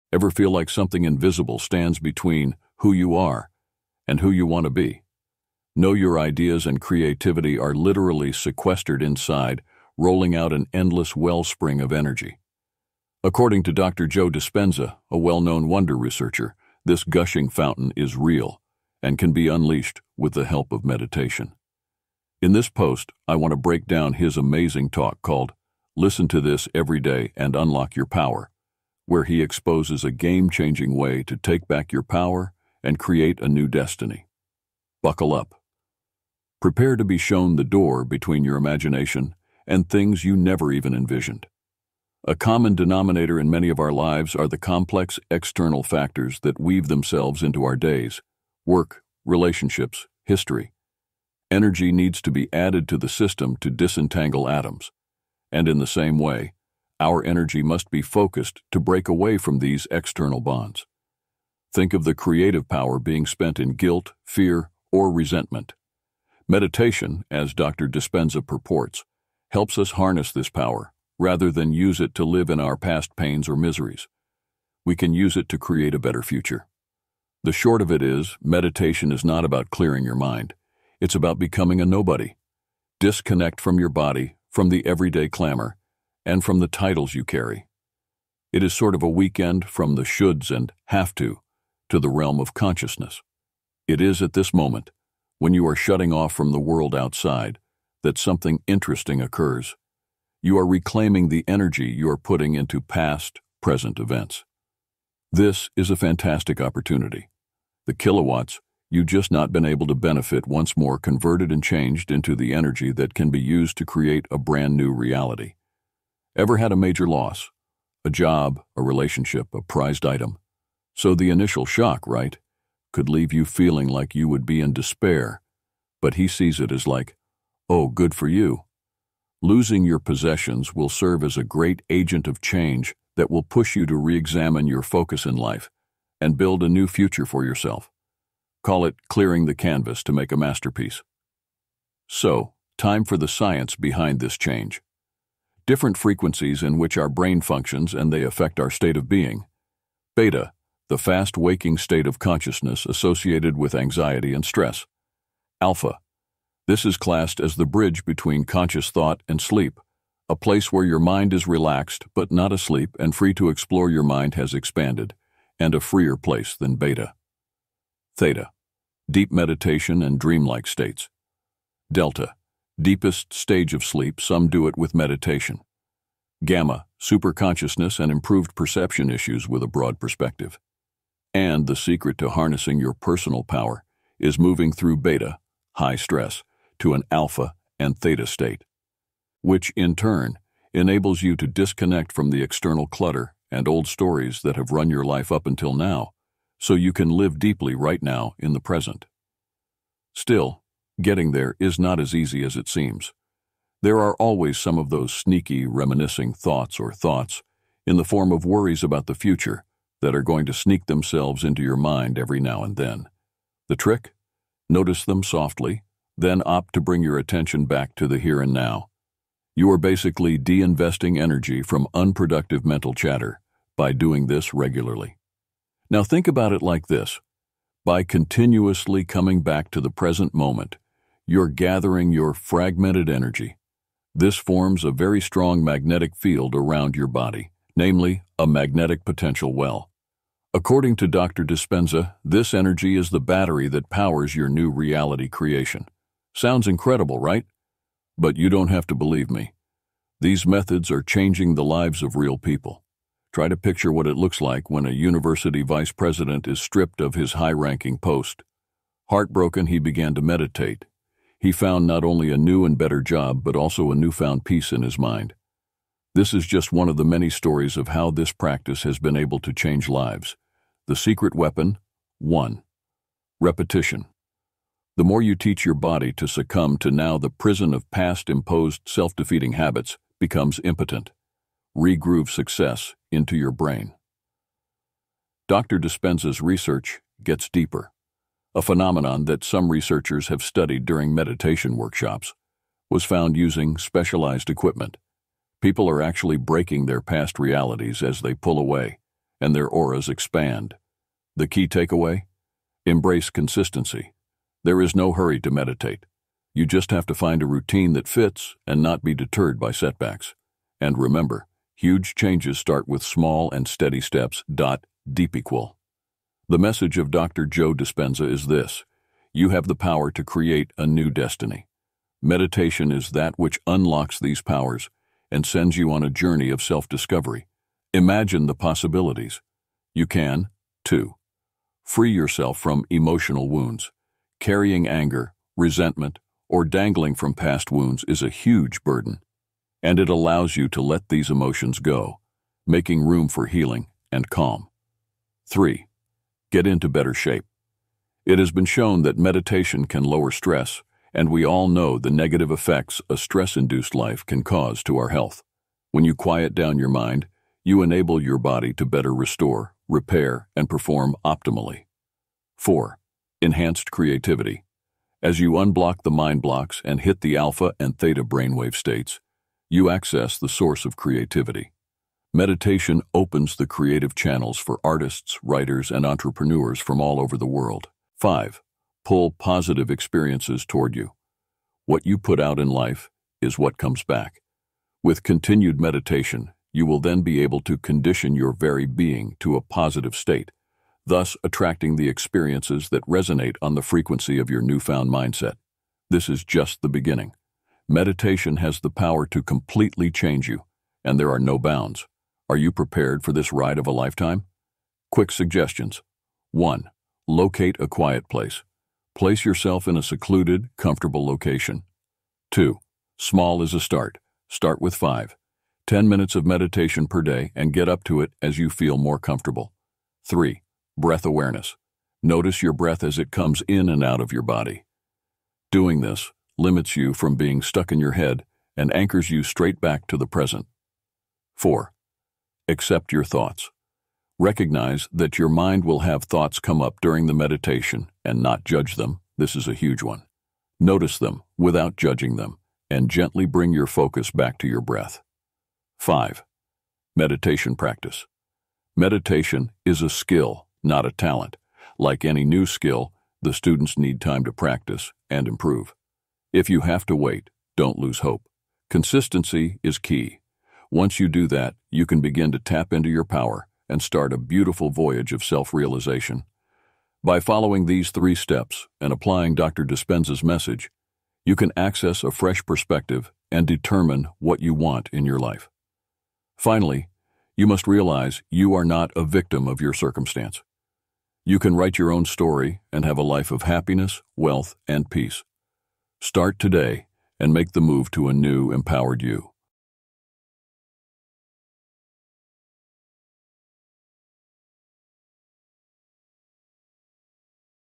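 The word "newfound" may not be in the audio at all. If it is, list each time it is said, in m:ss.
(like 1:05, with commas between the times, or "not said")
4:23, 6:34.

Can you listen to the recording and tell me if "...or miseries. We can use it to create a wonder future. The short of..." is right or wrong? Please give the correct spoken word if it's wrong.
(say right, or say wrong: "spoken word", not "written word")
wrong: "better", not "wonder".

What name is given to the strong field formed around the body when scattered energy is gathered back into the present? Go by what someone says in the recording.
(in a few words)
magnetic potential well.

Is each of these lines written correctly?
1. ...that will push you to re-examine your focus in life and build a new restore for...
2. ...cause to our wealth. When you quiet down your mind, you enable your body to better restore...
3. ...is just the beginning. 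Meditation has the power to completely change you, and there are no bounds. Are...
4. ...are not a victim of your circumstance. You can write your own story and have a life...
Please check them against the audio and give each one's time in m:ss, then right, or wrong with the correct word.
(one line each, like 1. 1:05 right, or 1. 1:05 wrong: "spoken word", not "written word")
1. 2:13 wrong: "future", not "restore"
2. 5:54 wrong: "health", not "wealth"
3. 6:36 right
4. 7:58 right.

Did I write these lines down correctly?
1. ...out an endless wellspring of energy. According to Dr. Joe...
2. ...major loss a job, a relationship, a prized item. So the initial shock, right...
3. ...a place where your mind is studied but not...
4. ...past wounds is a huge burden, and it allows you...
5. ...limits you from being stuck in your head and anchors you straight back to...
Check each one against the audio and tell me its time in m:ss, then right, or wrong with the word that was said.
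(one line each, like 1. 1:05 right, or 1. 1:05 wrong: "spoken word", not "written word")
1. 0:10 right
2. 1:56 right
3. 2:40 wrong: "relaxed", not "studied"
4. 5:37 right
5. 7:06 right.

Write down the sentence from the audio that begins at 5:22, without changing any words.
Meditation is that which unlocks these powers and sends you on a journey of self discovery.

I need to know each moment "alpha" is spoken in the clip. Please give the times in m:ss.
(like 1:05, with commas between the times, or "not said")
2:35, 3:07, 6:07.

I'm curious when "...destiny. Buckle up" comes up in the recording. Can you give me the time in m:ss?
0:33.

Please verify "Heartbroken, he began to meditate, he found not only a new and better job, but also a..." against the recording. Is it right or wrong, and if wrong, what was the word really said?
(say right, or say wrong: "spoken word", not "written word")
right.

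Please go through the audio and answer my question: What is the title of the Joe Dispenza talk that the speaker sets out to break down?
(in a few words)
Listen to This Every Day and Unlock Your Power.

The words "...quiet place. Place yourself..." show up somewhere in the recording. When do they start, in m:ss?
6:47.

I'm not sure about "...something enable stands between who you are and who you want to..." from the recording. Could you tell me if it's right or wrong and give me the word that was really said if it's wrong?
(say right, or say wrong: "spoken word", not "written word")
wrong: "invisible", not "enable".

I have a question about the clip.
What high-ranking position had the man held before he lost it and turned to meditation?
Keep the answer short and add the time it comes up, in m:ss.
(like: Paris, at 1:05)
university vice president, at 4:14.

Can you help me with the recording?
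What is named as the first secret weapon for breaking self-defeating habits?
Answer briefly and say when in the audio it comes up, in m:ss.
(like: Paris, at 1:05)
Repetition, at 4:33.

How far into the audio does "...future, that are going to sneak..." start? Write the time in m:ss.
3:29.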